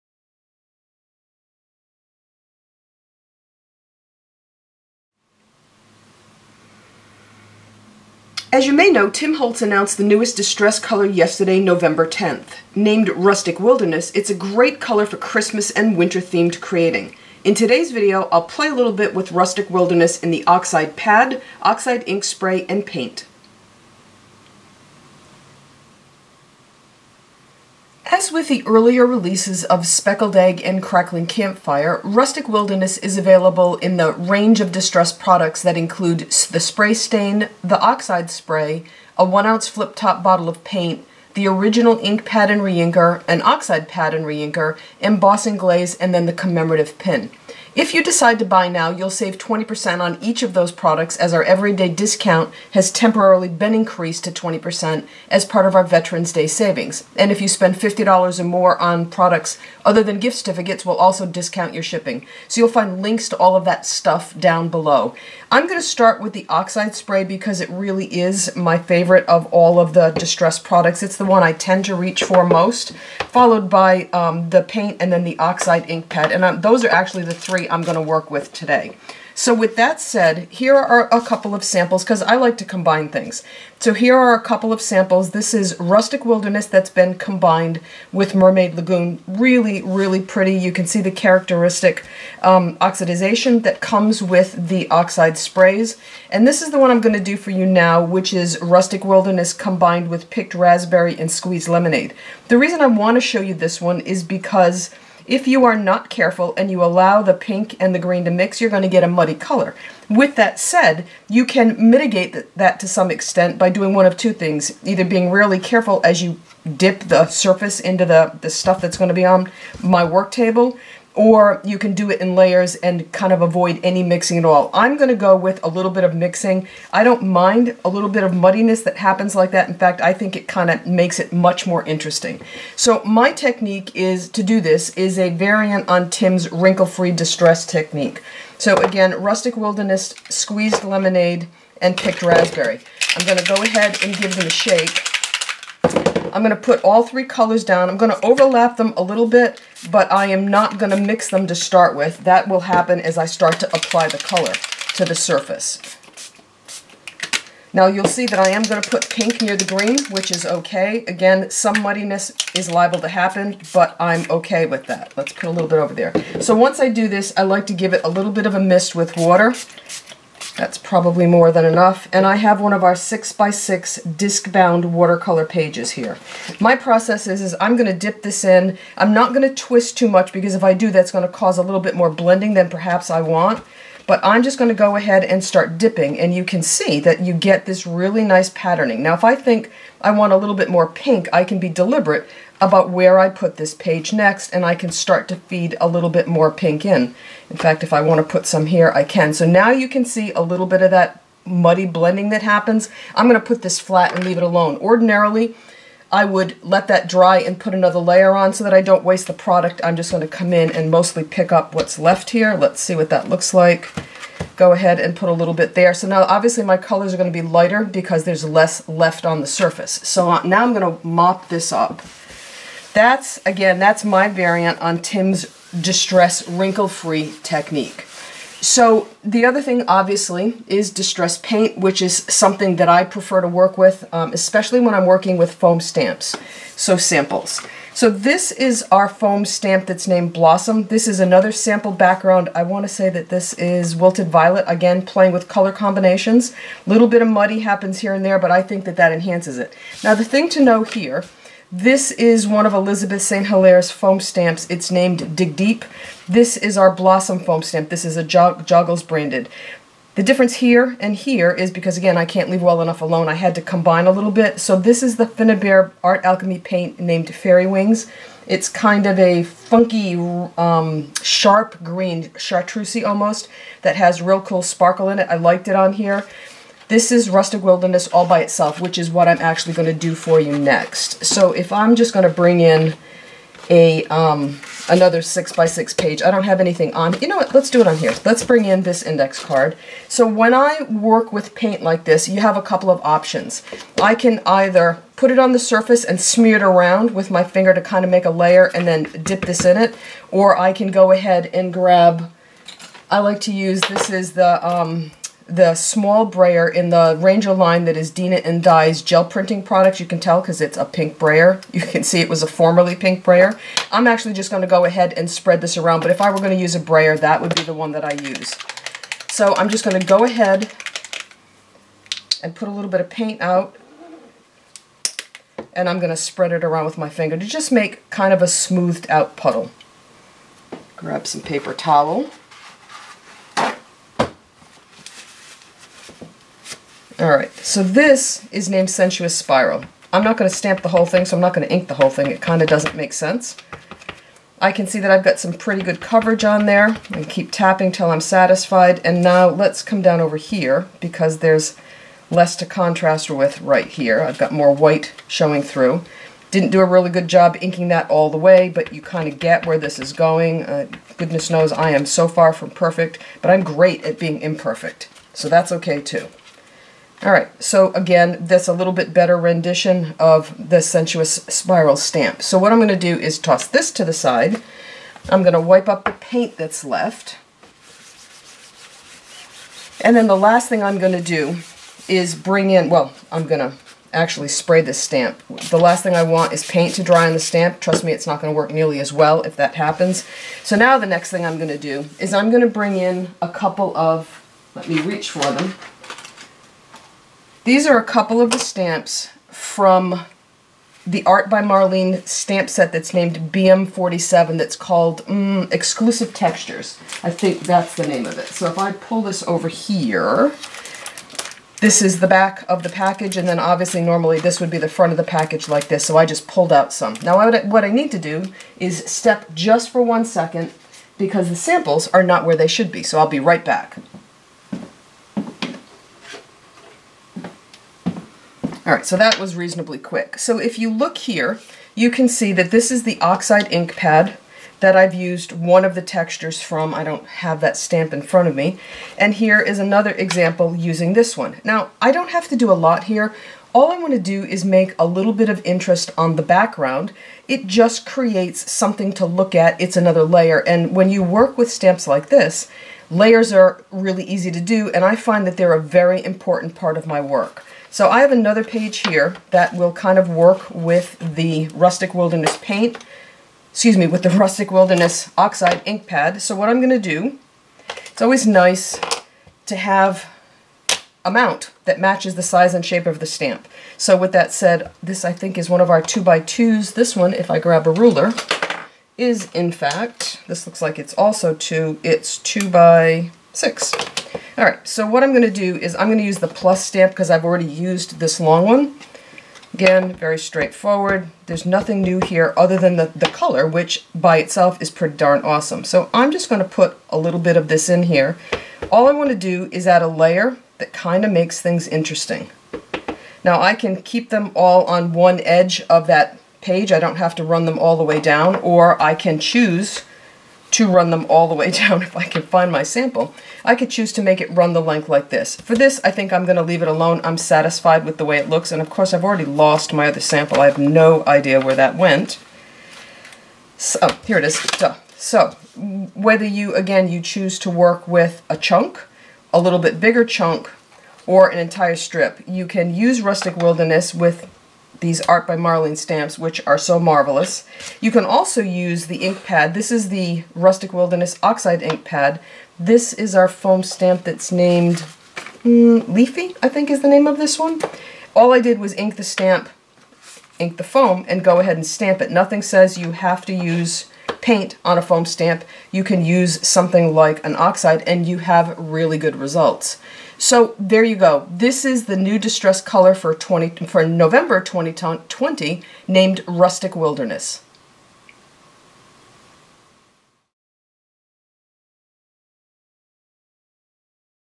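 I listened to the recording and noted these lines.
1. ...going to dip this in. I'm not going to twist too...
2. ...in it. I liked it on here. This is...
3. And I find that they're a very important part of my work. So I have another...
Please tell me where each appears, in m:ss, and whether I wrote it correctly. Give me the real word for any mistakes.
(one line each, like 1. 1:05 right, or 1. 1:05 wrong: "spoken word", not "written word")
1. 2:57 right
2. 4:35 right
3. 7:34 right.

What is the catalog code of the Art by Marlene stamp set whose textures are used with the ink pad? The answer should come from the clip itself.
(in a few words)
BM47.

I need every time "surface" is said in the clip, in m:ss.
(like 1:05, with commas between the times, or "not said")
1:57, 2:35, 3:39, 4:55.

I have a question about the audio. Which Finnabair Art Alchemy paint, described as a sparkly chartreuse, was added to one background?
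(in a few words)
Fairy Wings.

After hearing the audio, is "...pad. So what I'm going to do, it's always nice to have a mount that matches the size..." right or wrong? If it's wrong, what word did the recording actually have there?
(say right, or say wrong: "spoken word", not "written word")
right.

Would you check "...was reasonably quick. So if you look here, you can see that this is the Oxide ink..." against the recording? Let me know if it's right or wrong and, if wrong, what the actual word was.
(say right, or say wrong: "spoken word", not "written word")
right.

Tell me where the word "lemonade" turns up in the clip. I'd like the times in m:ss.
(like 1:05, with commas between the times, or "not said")
1:41, 2:20.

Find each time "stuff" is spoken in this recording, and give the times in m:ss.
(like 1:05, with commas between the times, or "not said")
1:03, 1:58.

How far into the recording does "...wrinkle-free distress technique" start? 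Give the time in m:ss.
2:16.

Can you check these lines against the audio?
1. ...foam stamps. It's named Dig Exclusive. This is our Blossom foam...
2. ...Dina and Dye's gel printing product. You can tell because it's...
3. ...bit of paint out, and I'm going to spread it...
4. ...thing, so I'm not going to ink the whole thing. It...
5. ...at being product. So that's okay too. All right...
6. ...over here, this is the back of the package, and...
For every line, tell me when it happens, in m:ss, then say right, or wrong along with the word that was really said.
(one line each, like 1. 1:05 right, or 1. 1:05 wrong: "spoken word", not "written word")
1. 4:13 wrong: "Deep", not "Exclusive"
2. 5:08 right
3. 5:22 right
4. 5:41 right
5. 6:04 wrong: "imperfect", not "product"
6. 6:49 right.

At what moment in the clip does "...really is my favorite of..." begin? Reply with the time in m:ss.
1:07.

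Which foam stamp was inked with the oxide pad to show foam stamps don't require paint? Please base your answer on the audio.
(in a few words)
Leafy.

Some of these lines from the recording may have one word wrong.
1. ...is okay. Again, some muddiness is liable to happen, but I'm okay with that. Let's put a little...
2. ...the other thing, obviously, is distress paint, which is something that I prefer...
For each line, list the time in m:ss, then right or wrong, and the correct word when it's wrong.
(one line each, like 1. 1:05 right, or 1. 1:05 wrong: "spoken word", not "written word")
1. 2:40 right
2. 3:49 right.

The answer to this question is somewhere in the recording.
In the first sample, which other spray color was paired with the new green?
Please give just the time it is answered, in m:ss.
1:28.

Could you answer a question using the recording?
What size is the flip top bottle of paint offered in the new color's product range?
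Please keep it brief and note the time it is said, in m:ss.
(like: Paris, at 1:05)
1 ounce, at 0:39.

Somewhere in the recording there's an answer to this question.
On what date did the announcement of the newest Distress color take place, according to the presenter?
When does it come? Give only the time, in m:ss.
0:11.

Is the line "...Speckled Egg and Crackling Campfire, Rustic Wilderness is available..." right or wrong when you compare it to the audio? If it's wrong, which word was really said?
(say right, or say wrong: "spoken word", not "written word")
right.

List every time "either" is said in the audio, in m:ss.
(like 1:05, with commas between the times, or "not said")
1:54, 4:54.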